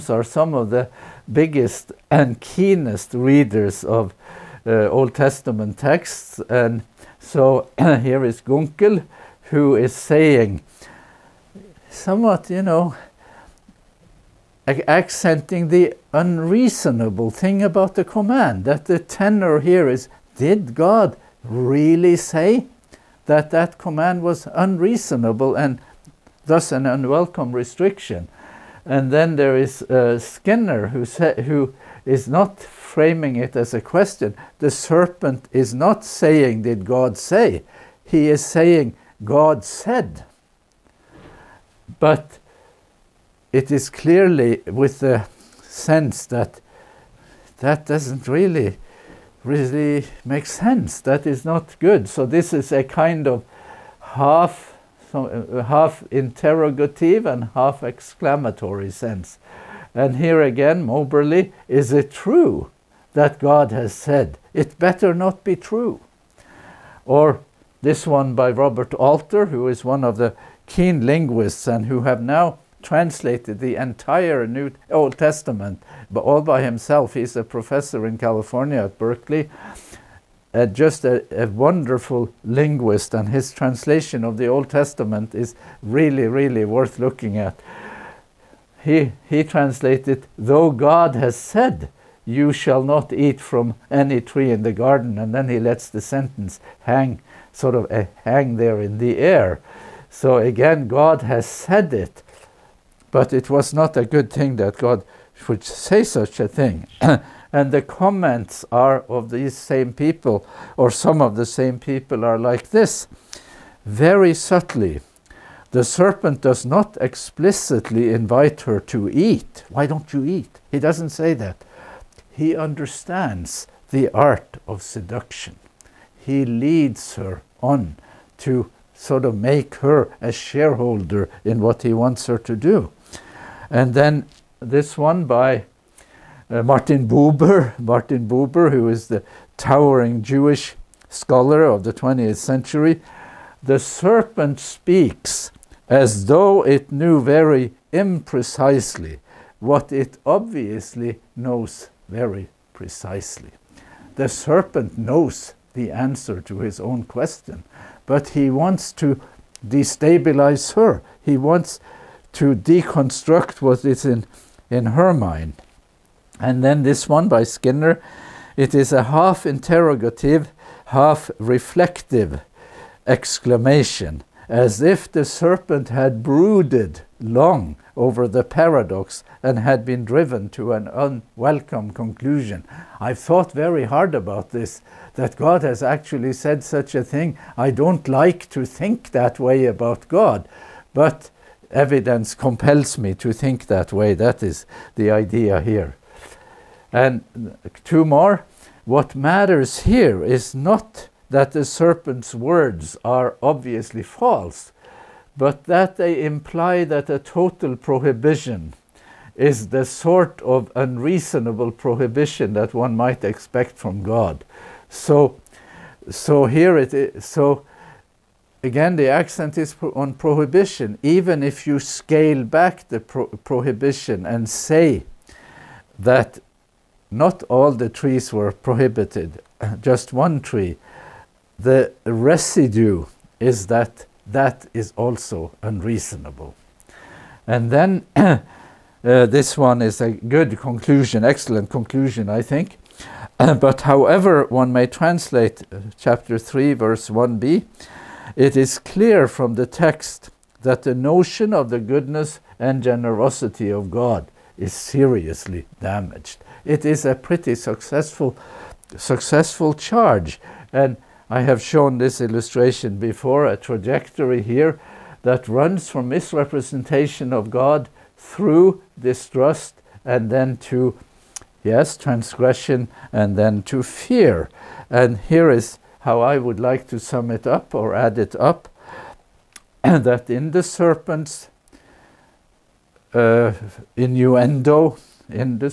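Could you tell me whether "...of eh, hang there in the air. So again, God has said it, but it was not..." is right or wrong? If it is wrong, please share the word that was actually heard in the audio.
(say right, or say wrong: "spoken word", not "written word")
right.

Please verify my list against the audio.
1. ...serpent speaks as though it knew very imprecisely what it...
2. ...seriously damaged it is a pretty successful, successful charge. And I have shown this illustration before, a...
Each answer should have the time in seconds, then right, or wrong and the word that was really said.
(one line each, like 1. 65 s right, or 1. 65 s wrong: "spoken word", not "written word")
1. 143 s right
2. 254 s right.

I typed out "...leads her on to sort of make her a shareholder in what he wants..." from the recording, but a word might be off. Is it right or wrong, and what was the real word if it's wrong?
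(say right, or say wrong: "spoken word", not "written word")
right.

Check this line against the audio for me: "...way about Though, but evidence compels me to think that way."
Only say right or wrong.
wrong.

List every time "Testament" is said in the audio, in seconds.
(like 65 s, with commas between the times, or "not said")
5 s, 75 s, 84 s.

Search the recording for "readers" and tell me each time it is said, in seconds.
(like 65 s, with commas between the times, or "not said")
3 s.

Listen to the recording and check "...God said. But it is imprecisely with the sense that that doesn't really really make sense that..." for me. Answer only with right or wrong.
wrong.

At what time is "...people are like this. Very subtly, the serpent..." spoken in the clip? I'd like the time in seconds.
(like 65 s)
111 s.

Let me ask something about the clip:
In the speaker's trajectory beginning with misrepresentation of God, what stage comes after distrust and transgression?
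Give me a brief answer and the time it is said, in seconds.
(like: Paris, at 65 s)
Fear, at 273 s.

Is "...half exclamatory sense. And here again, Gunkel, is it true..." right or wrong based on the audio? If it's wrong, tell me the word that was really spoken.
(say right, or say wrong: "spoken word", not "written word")
wrong: "Moberly", not "Gunkel".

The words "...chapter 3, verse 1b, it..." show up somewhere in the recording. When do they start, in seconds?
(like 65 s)
245 s.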